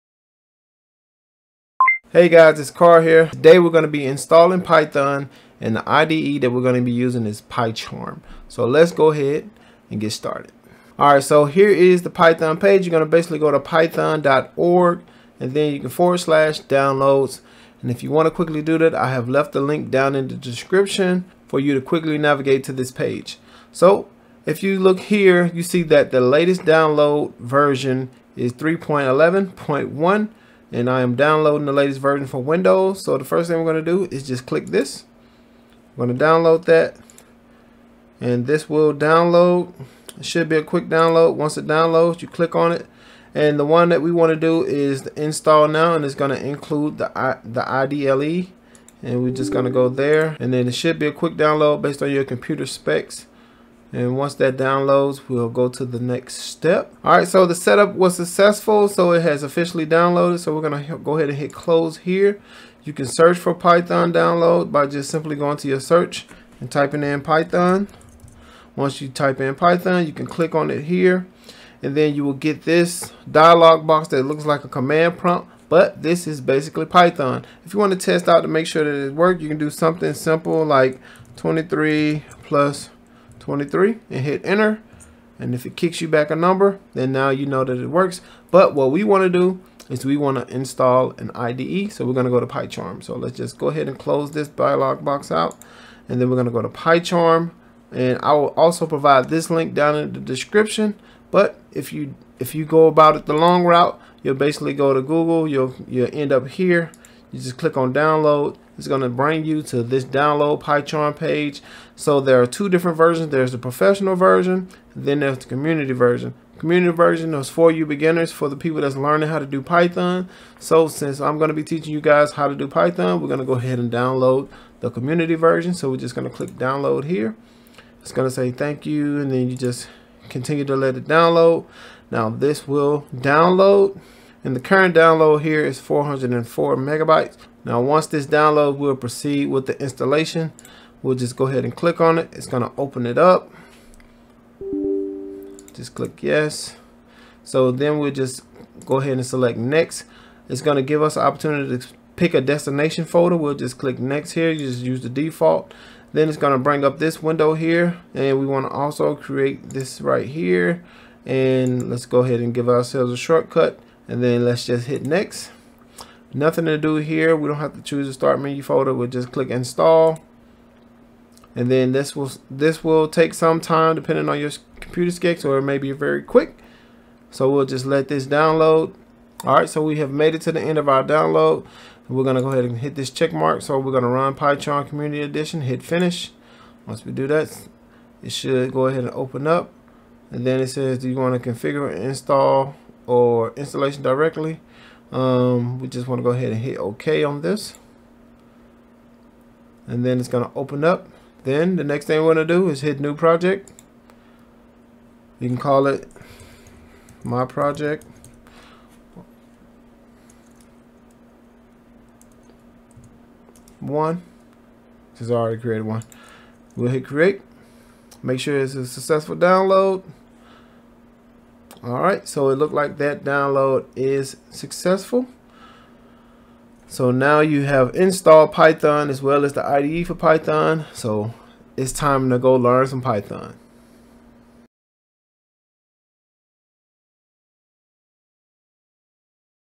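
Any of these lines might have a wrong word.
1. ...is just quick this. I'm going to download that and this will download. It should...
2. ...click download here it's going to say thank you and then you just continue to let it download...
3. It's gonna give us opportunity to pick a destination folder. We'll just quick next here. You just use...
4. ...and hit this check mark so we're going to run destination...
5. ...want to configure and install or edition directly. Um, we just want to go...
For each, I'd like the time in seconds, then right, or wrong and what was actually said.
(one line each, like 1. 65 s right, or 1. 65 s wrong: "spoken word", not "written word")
1. 34 s wrong: "click", not "quick"
2. 126 s right
3. 150 s wrong: "click", not "quick"
4. 182 s wrong: "python", not "destination"
5. 191 s wrong: "installation", not "edition".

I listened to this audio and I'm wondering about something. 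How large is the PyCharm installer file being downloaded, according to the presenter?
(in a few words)
404 megabytes.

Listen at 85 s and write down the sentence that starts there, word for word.
And if it kicks you back a number, then now you know that it works.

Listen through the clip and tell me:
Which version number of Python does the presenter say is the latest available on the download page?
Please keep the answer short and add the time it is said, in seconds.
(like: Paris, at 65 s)
3.11.1, at 28 s.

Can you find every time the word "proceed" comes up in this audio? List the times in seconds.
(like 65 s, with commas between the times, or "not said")
138 s.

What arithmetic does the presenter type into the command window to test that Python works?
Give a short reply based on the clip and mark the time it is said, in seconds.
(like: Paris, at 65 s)
23 plus 23, at 81 s.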